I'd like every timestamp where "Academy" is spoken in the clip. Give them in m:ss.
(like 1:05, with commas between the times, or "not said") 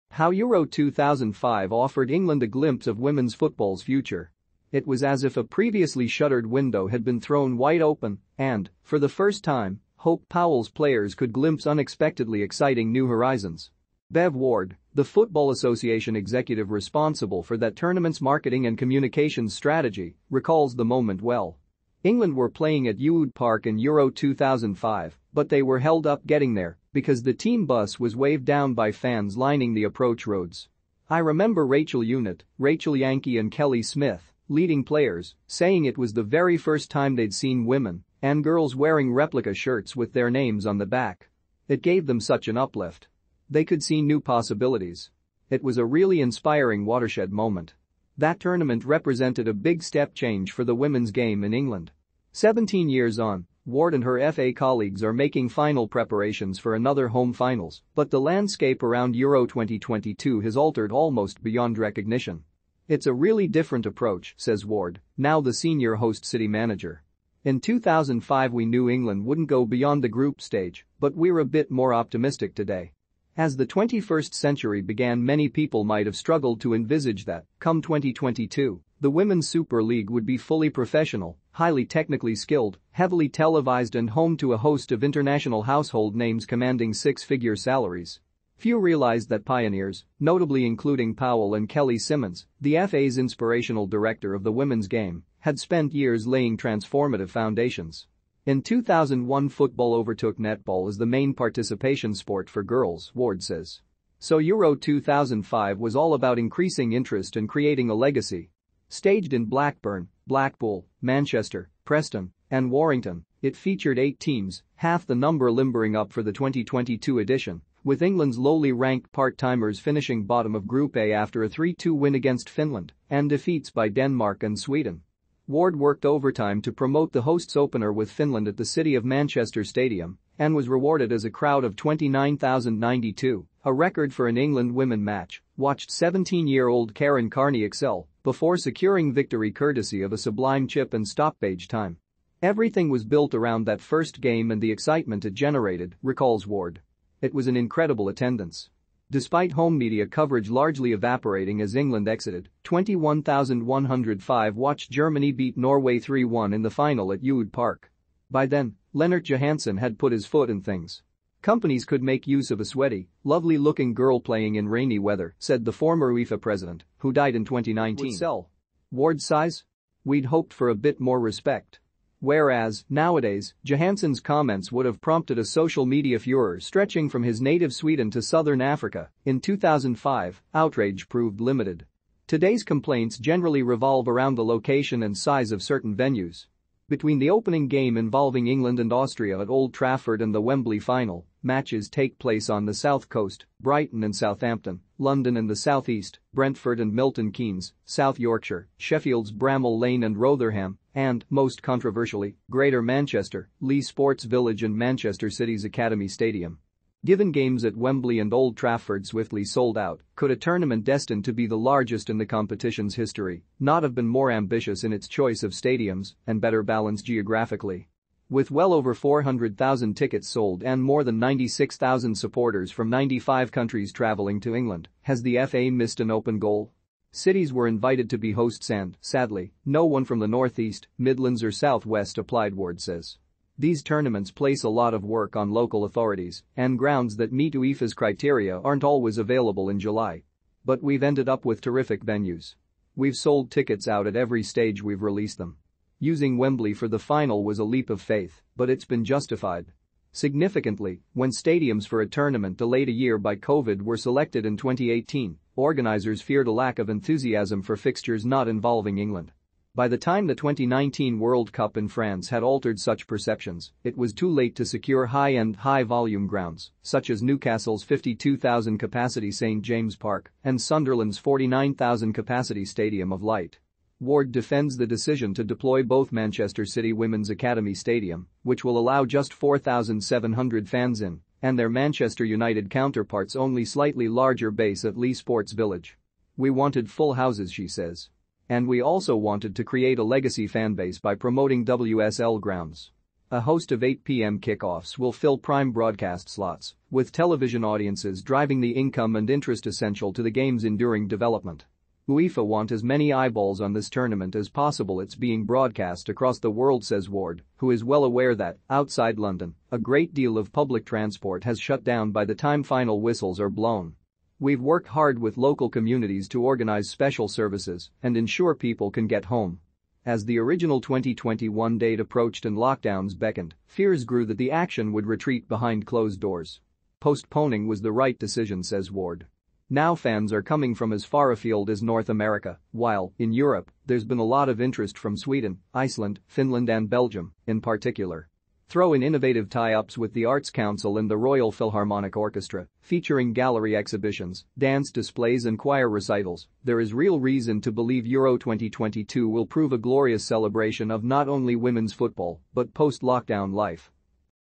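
3:25, 4:37.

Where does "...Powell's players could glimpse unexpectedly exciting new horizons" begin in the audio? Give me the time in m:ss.
0:10.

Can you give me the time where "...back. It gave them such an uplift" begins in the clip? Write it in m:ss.
0:40.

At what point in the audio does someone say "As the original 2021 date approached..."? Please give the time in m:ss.
5:20.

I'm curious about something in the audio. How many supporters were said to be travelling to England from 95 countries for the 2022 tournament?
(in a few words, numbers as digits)
96,000.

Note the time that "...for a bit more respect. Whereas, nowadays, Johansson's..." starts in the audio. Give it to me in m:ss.
2:50.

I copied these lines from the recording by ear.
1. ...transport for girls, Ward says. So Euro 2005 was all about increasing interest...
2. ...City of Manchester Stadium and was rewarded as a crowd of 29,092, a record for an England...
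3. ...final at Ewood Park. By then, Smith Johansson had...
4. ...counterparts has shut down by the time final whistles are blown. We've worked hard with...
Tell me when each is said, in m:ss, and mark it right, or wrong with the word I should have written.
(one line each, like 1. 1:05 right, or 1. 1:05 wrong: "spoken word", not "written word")
1. 1:42 wrong: "sport", not "transport"
2. 2:08 right
3. 2:36 wrong: "Lennart", not "Smith"
4. 5:10 wrong: "transport", not "counterparts".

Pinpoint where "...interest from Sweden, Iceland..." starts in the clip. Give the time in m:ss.
5:34.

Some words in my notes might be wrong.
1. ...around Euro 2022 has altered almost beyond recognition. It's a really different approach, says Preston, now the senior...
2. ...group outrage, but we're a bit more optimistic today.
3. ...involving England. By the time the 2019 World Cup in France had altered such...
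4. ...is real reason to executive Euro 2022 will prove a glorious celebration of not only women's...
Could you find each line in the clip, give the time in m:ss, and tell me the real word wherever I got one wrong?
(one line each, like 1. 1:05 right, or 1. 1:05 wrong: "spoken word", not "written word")
1. 0:58 wrong: "Ward", not "Preston"
2. 1:10 wrong: "stage", not "outrage"
3. 4:18 right
4. 5:46 wrong: "believe", not "executive".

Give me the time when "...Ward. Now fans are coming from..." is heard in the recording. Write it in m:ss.
5:28.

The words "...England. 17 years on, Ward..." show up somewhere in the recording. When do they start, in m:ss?
0:51.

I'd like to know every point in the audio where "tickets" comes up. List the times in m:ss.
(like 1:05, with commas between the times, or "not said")
3:39, 4:03.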